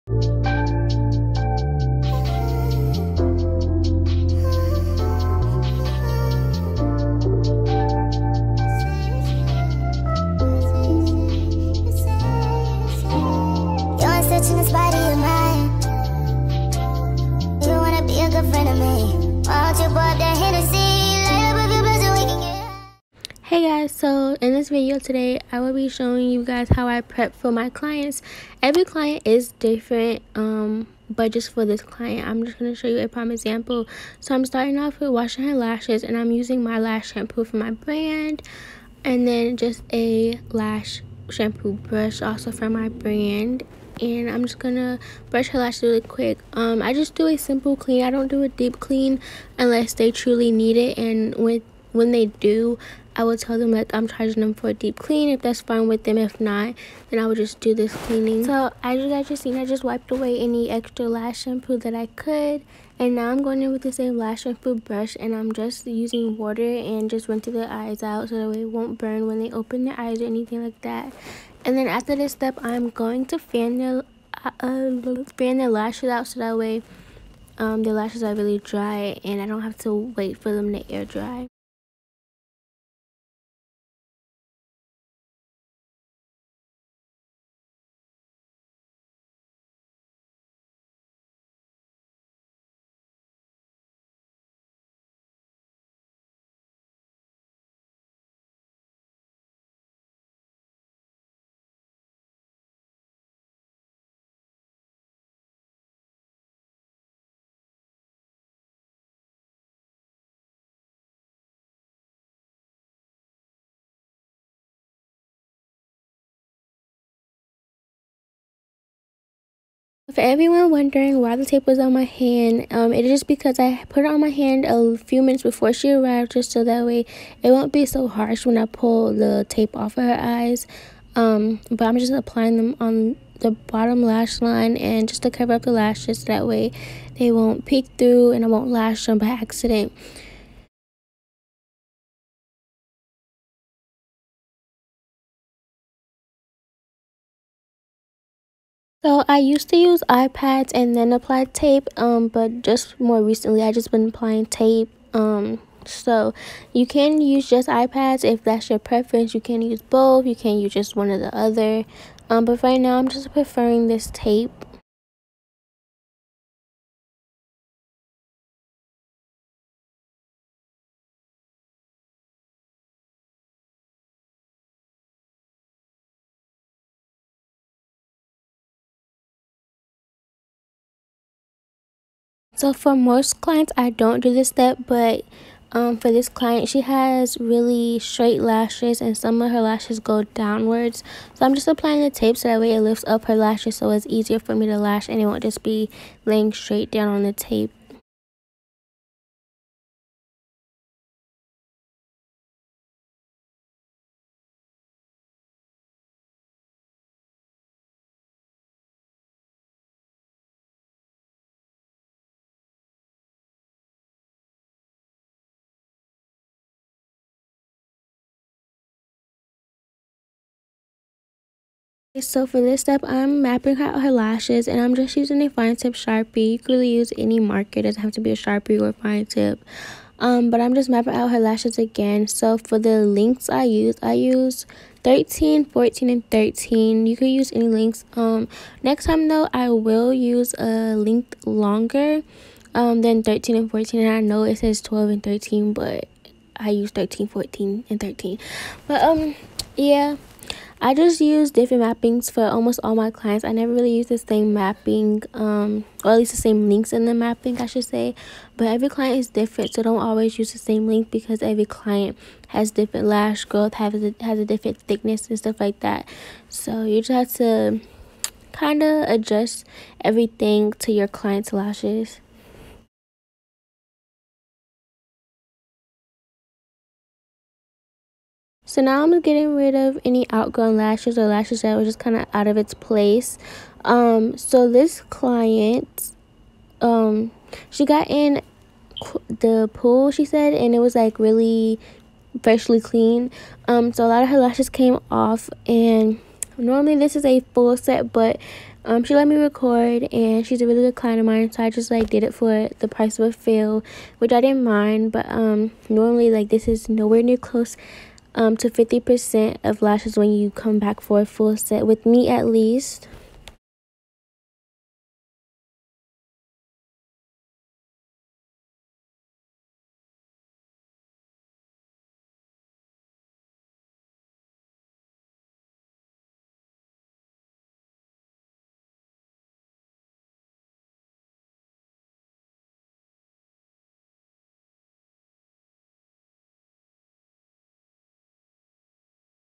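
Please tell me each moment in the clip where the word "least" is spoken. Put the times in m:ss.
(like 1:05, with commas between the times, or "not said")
4:16, 5:12.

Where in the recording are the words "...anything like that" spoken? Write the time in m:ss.
1:10.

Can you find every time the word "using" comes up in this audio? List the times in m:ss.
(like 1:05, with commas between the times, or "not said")
0:36, 1:05, 3:45.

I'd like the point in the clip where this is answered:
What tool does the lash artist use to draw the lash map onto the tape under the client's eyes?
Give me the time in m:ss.
3:45.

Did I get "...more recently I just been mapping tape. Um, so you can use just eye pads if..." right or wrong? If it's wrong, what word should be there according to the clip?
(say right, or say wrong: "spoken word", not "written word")
wrong: "applying", not "mapping".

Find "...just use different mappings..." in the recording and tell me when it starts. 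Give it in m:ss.
4:10.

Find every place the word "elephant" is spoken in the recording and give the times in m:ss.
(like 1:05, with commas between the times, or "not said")
not said.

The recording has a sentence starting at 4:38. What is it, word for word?
So now I'm getting rid of any outgrown lashes or lashes that were just kind of out of its place.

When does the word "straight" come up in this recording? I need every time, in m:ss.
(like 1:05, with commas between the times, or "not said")
3:07, 3:16.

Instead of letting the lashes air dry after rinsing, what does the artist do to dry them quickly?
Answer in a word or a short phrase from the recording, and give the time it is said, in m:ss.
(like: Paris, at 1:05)
fan their lashes, at 1:15.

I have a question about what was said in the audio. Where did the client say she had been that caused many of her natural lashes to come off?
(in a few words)
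the pool.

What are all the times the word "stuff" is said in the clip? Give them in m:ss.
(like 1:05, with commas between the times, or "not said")
4:25.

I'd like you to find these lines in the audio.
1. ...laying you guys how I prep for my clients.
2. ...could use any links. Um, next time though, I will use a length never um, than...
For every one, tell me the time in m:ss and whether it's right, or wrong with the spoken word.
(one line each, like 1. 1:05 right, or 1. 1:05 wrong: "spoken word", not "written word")
1. 0:25 wrong: "showing", not "laying"
2. 3:57 wrong: "longer", not "never".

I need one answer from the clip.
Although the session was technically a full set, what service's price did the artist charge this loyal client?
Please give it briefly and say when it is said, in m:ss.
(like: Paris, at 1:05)
a fill, at 5:03.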